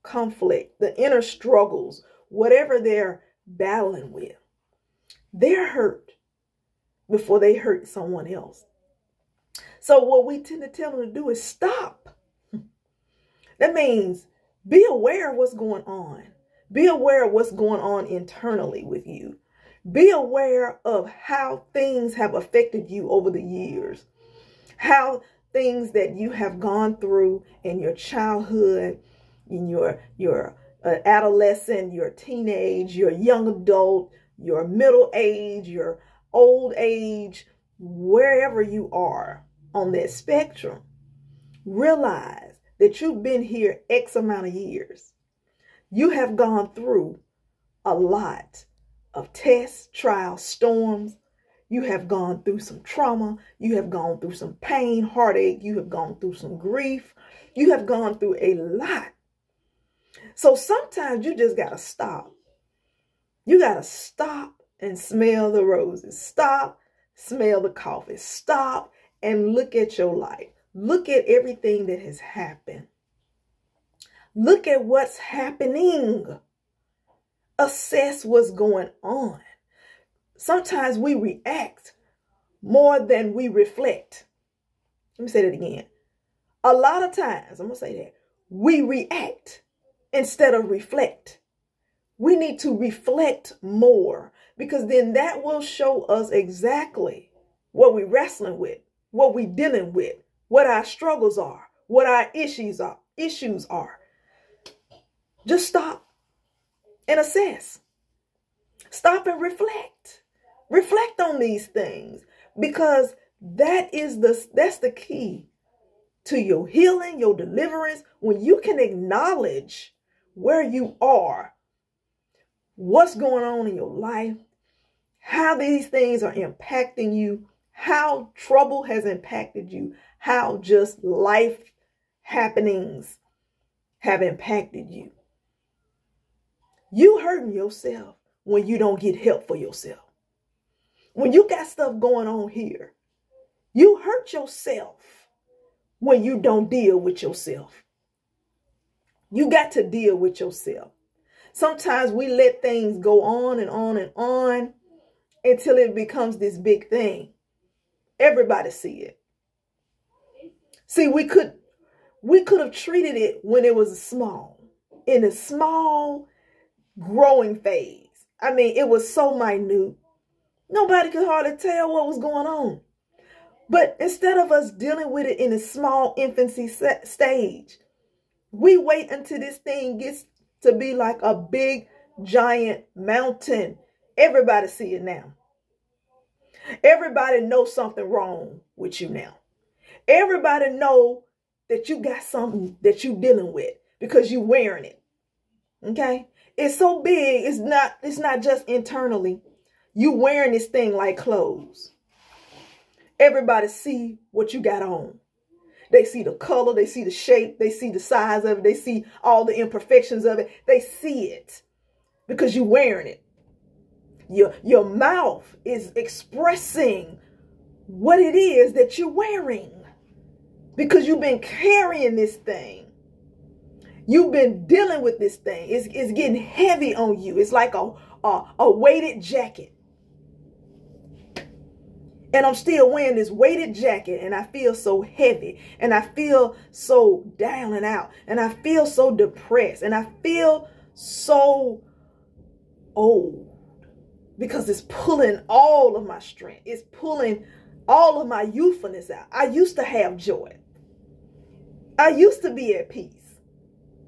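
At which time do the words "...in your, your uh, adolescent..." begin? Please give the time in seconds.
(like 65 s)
29 s.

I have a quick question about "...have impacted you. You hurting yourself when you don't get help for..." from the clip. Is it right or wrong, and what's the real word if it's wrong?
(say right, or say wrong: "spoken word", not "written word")
right.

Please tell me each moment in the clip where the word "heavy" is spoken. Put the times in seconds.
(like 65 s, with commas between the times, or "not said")
226 s, 235 s.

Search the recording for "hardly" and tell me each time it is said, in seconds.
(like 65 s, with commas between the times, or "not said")
171 s.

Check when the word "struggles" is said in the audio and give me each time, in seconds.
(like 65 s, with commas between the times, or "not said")
1 s, 100 s.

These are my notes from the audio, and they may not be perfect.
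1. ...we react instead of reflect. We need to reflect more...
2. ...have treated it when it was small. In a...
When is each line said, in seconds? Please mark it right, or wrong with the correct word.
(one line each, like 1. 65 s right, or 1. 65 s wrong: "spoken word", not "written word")
1. 88 s right
2. 162 s right.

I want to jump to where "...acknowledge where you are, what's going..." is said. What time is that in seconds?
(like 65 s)
118 s.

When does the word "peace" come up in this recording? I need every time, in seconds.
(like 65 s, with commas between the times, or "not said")
252 s.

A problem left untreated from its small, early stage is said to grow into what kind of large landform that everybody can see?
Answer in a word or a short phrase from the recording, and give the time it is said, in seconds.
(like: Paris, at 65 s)
giant mountain, at 182 s.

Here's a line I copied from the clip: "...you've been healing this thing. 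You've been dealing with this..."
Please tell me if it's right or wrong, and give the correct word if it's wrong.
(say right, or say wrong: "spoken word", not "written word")
wrong: "carrying", not "healing".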